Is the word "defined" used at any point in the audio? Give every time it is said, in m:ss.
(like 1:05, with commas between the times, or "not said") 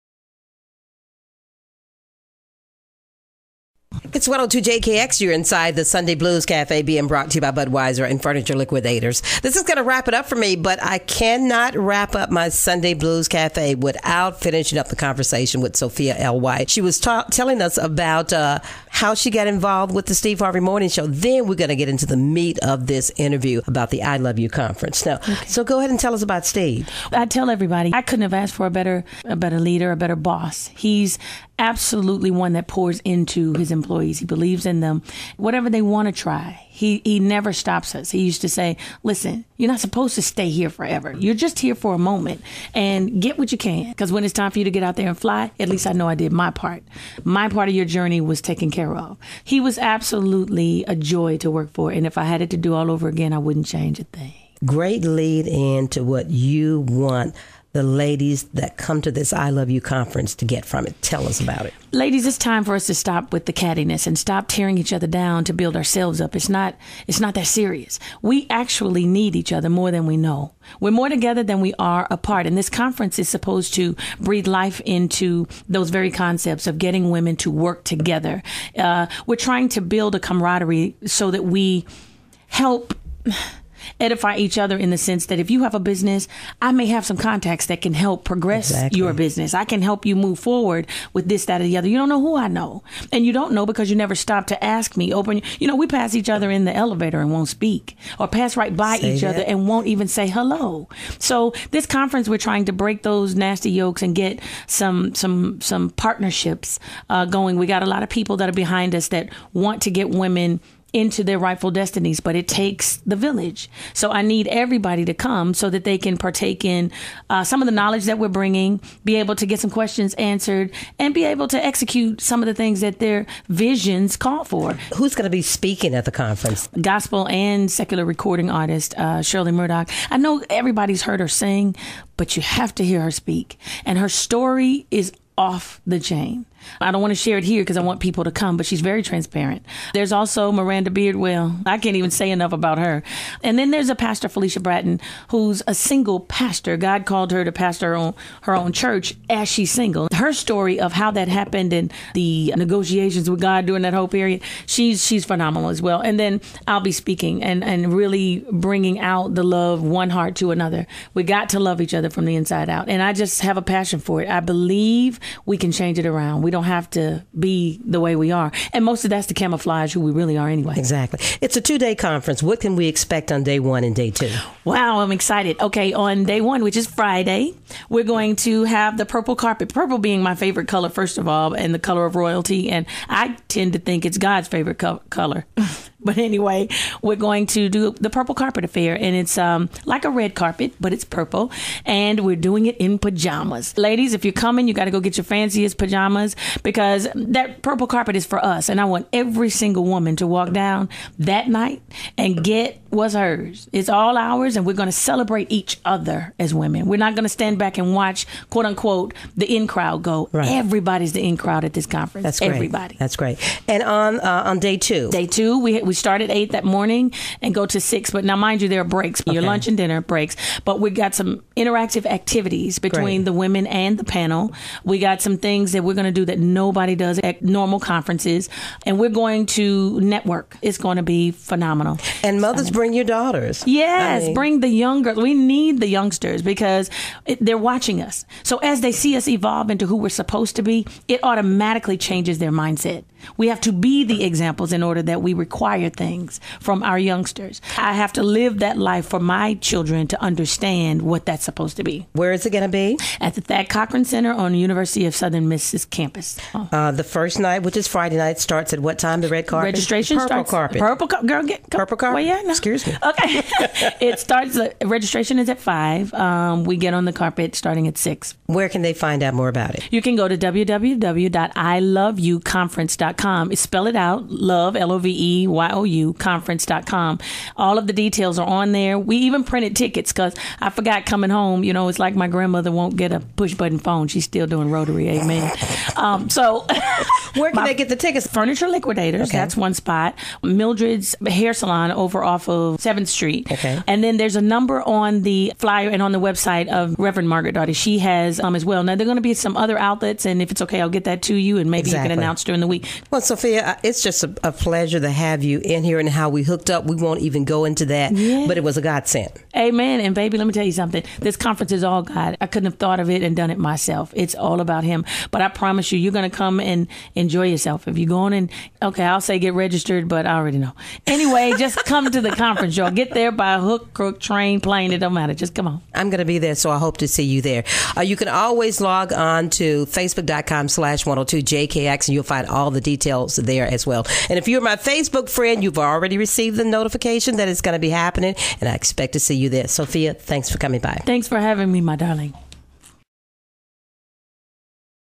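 not said.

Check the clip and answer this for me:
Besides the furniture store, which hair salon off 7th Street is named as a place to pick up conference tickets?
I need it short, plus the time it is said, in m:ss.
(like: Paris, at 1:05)
Mildred's Hair Salon, at 4:50.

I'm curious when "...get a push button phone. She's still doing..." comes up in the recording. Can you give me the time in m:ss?
4:42.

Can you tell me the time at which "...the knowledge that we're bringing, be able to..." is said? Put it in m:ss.
1:57.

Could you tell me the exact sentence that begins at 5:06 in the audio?
We won't even go into that, yeah.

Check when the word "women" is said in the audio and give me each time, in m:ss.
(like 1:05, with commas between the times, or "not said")
1:17, 1:50, 3:26, 3:43.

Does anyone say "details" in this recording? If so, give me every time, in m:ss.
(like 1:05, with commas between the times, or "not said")
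4:37, 5:32.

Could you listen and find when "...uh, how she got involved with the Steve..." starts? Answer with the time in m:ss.
0:18.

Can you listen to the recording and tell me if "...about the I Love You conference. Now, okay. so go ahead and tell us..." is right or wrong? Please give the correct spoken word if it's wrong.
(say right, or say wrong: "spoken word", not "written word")
right.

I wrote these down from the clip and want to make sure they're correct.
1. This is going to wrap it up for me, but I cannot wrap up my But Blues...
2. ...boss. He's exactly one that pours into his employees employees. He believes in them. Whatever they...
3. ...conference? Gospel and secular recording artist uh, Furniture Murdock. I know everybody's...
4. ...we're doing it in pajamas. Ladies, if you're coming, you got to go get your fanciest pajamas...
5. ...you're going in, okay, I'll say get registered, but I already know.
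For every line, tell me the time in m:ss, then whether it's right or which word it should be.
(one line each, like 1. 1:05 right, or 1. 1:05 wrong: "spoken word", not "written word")
1. 0:09 wrong: "Sunday", not "But"
2. 0:30 wrong: "absolutely", not "exactly"
3. 2:06 wrong: "Shirley", not "Furniture"
4. 3:12 right
5. 5:17 right.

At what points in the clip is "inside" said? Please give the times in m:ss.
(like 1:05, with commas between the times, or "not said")
0:05, 2:42.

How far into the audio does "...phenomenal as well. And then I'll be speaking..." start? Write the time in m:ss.
2:35.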